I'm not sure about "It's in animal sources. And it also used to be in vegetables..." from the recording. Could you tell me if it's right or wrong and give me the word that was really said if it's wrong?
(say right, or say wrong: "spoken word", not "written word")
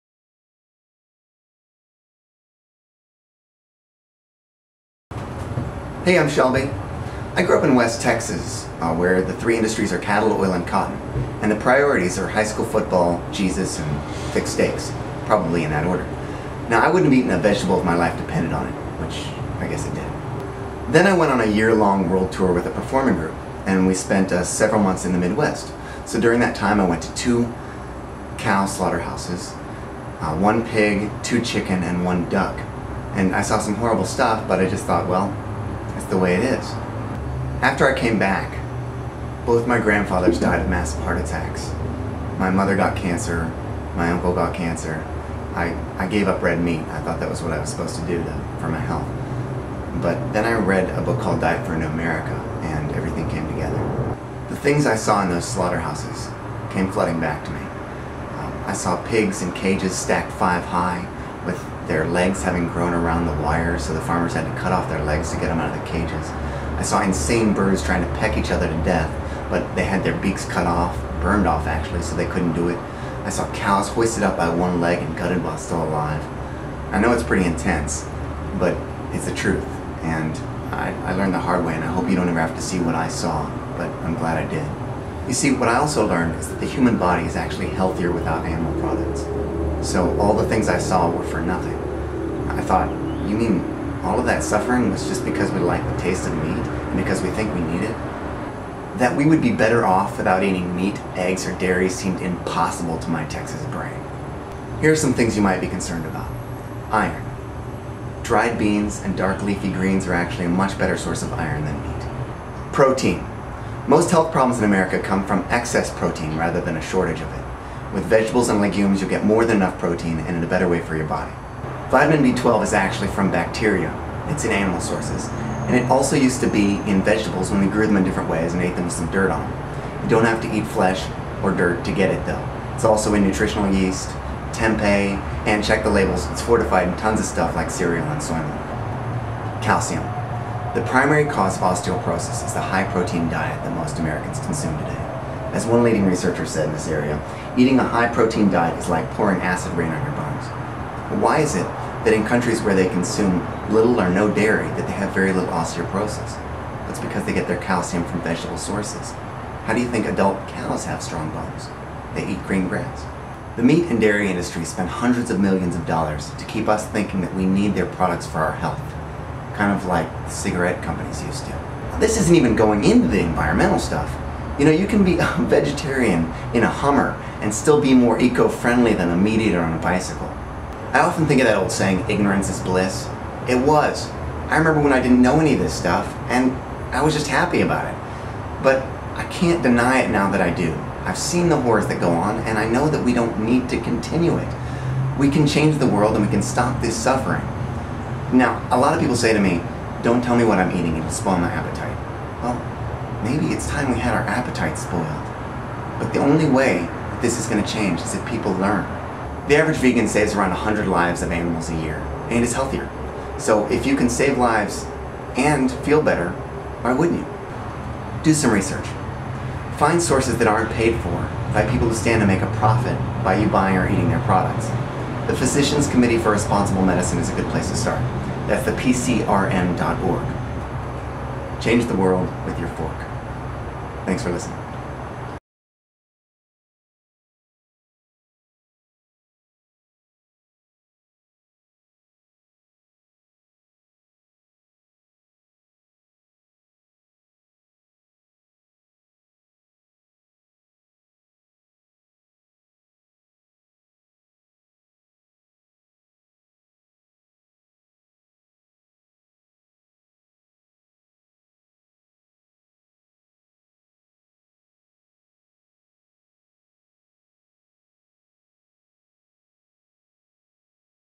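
right.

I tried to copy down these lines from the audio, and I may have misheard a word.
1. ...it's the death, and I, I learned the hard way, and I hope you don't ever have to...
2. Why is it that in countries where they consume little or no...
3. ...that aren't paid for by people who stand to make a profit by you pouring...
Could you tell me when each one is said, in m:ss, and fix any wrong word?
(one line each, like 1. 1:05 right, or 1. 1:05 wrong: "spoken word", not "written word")
1. 1:19 wrong: "truth", not "death"
2. 2:31 right
3. 3:40 wrong: "buying", not "pouring".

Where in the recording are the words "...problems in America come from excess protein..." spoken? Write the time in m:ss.
1:54.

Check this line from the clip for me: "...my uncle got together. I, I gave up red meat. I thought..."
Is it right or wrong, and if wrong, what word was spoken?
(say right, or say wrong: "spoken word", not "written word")
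wrong: "cancer", not "together".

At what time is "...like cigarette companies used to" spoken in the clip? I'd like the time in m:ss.
2:49.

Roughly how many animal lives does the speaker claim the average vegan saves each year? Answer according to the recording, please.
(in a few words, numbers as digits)
100.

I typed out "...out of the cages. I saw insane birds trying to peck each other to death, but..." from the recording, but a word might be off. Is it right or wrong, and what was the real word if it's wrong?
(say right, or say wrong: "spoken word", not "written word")
right.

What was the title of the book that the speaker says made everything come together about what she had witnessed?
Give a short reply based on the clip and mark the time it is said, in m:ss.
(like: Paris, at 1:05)
Diet for a New America, at 0:51.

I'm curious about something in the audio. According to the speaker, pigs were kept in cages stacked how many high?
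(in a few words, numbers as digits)
5.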